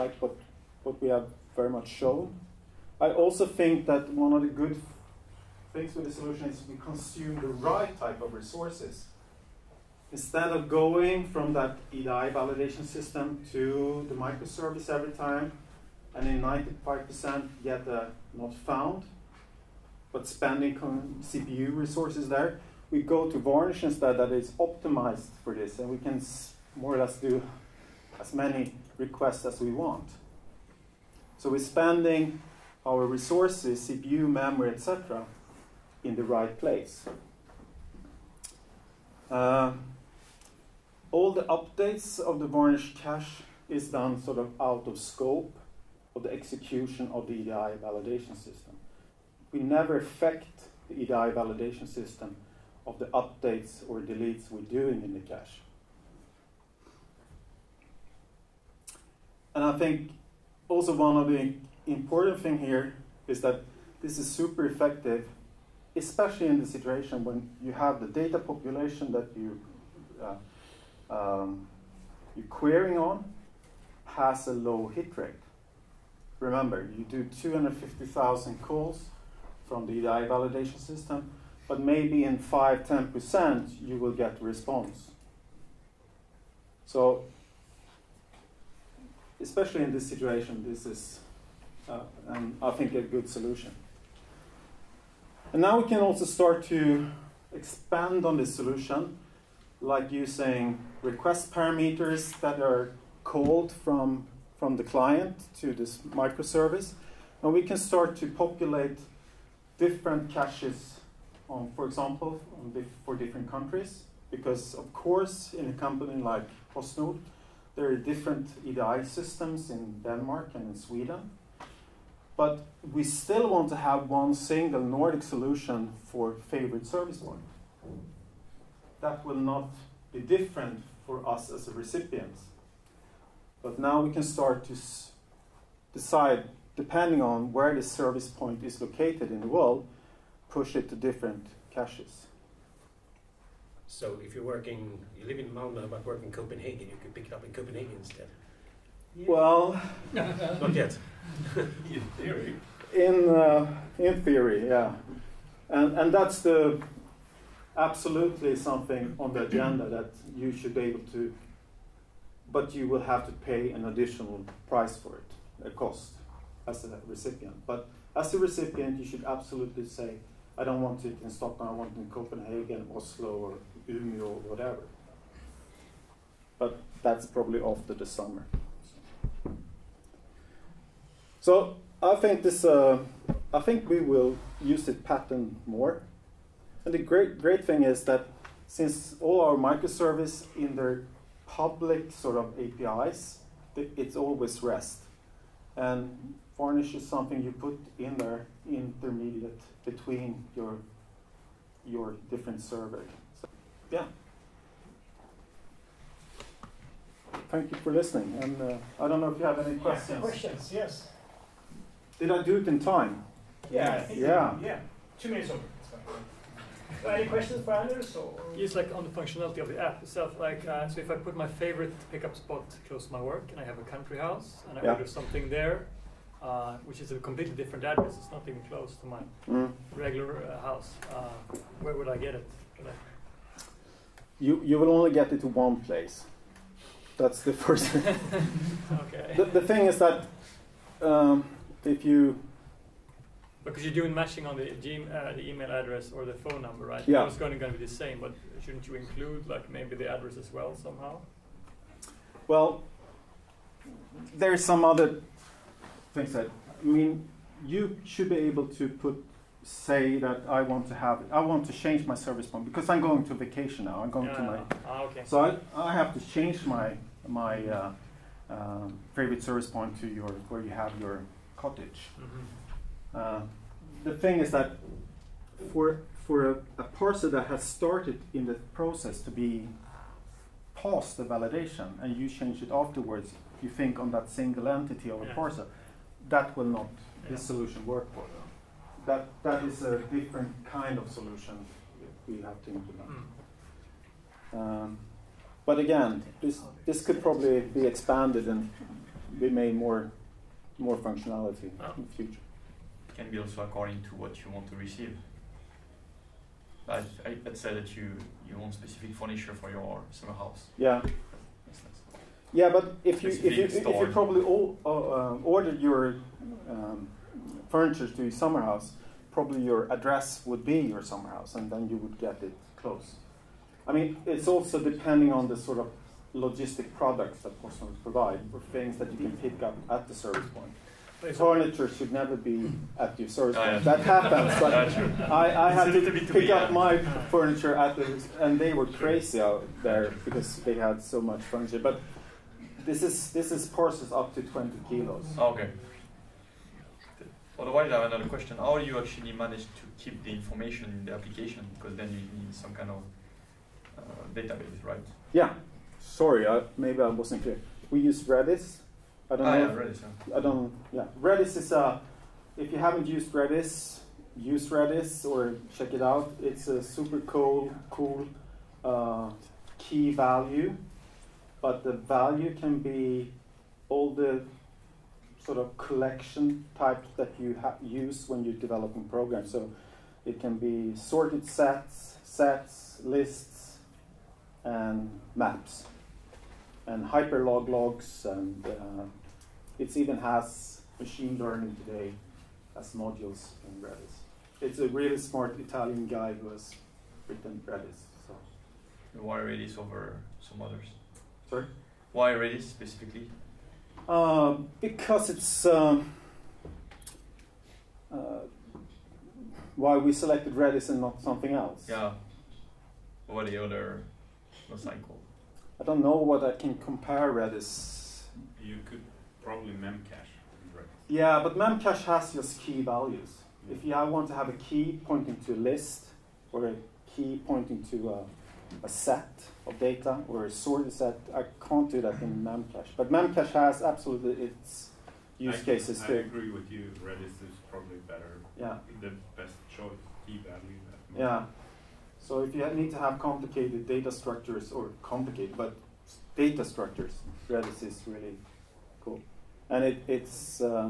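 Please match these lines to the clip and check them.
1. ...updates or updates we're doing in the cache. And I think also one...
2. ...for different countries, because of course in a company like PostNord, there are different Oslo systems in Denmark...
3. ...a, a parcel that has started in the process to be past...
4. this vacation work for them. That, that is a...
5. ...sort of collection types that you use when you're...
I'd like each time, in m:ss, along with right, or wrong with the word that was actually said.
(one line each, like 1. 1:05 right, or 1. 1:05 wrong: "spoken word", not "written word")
1. 0:53 wrong: "deletes", not "updates"
2. 1:53 wrong: "EDI", not "Oslo"
3. 4:36 right
4. 4:47 wrong: "solution", not "vacation"
5. 6:15 right.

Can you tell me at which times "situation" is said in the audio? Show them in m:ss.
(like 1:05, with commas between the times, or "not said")
1:06, 1:30.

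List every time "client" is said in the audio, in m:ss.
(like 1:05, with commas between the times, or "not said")
1:44.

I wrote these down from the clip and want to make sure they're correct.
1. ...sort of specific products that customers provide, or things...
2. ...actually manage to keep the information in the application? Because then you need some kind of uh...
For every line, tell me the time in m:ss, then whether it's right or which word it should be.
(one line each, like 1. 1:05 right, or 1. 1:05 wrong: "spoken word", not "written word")
1. 5:25 wrong: "logistic", not "specific"
2. 5:48 right.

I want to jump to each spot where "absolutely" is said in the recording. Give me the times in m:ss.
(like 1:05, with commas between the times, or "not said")
2:37, 2:49, 7:13.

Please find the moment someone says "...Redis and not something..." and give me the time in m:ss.
6:50.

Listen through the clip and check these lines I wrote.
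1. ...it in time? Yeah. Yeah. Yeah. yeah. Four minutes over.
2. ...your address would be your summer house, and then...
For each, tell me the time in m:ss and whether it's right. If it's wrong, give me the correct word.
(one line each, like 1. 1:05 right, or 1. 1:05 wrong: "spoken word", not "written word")
1. 3:32 wrong: "Two", not "Four"
2. 5:19 right.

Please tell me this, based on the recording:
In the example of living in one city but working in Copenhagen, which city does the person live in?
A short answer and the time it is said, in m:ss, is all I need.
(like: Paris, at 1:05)
Malmo, at 2:25.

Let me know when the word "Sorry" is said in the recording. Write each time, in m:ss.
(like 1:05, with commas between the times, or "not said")
5:55, 6:41.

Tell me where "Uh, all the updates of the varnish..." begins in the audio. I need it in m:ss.
0:39.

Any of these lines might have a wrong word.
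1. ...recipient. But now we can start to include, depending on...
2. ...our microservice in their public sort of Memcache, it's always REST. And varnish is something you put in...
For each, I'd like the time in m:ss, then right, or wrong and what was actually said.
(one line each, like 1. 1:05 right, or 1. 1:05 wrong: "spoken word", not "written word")
1. 2:11 wrong: "decide", not "include"
2. 3:09 wrong: "APIs", not "Memcache".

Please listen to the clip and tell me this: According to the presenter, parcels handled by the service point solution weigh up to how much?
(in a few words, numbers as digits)
20 kilos.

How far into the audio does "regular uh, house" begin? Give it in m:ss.
3:49.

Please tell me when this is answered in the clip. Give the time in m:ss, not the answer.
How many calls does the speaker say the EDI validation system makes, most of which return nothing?
1:17.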